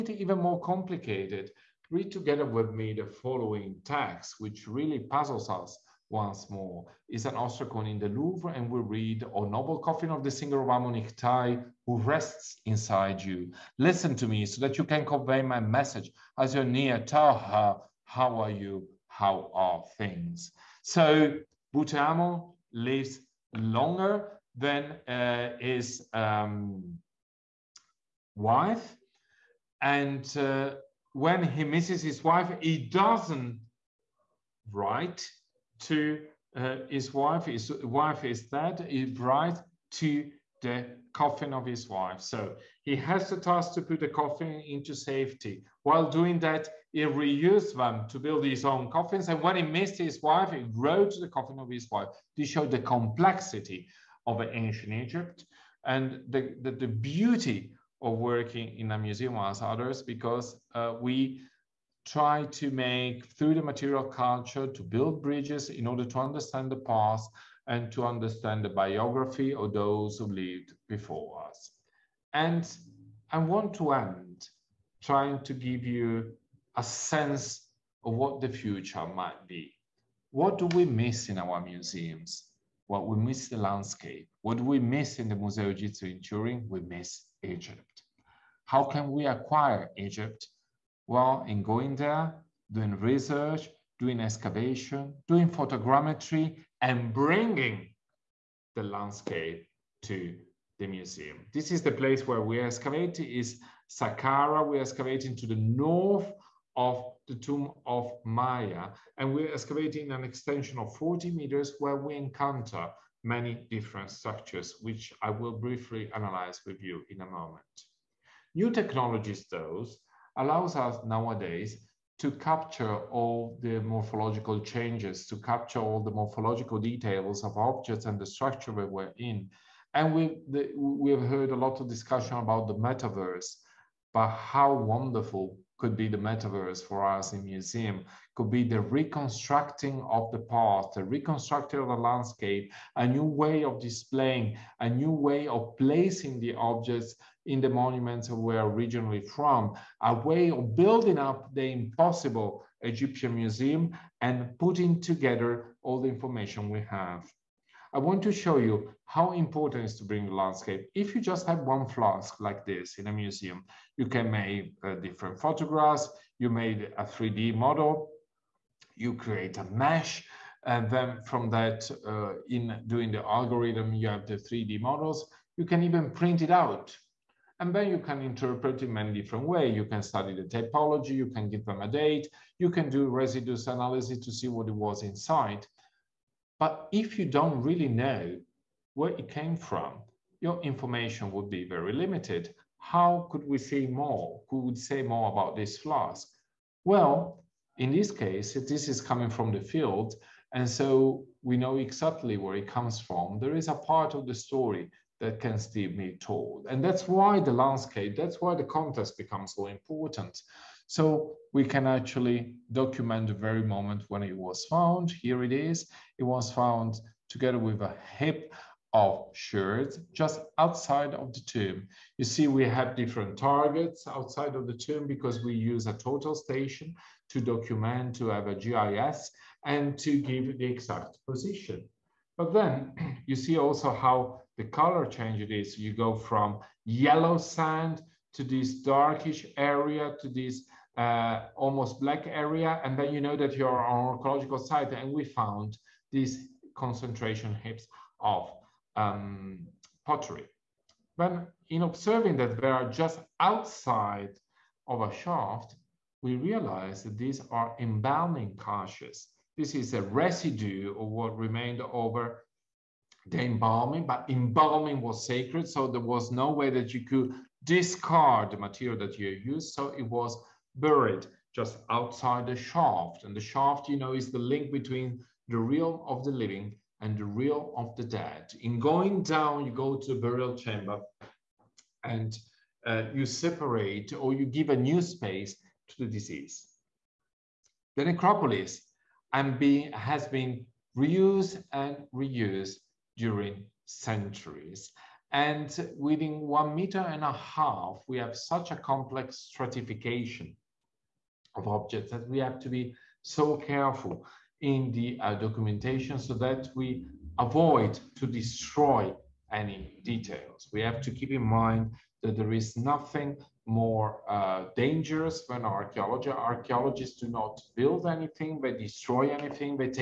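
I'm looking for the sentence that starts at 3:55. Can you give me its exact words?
You go from yellow sand to this darkish area to this uh, almost black area.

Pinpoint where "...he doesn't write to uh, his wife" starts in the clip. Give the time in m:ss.
0:32.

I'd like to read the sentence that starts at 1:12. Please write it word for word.
And I want to end trying to give you a sense of what the future might be.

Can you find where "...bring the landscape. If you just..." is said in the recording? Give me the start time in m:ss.
2:40.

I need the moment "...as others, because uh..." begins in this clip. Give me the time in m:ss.
0:59.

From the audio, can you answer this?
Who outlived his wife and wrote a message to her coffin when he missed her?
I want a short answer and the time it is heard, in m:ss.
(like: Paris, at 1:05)
Butehamon, at 0:21.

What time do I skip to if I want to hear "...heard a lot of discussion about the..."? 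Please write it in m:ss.
2:11.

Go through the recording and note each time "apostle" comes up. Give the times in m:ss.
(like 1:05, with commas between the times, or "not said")
not said.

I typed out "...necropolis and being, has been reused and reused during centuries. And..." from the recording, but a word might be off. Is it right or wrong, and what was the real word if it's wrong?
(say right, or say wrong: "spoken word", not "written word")
right.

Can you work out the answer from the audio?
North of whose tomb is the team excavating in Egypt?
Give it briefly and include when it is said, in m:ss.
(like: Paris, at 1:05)
Maya, at 1:48.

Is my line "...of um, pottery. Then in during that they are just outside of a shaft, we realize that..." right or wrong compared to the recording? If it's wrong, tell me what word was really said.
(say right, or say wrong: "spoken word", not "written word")
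wrong: "observing", not "during".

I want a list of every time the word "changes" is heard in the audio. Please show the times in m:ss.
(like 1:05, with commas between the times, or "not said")
2:04, 3:55.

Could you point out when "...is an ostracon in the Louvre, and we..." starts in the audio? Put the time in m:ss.
0:07.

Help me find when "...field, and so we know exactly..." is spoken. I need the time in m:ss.
3:19.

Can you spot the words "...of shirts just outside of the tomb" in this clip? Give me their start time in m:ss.
3:38.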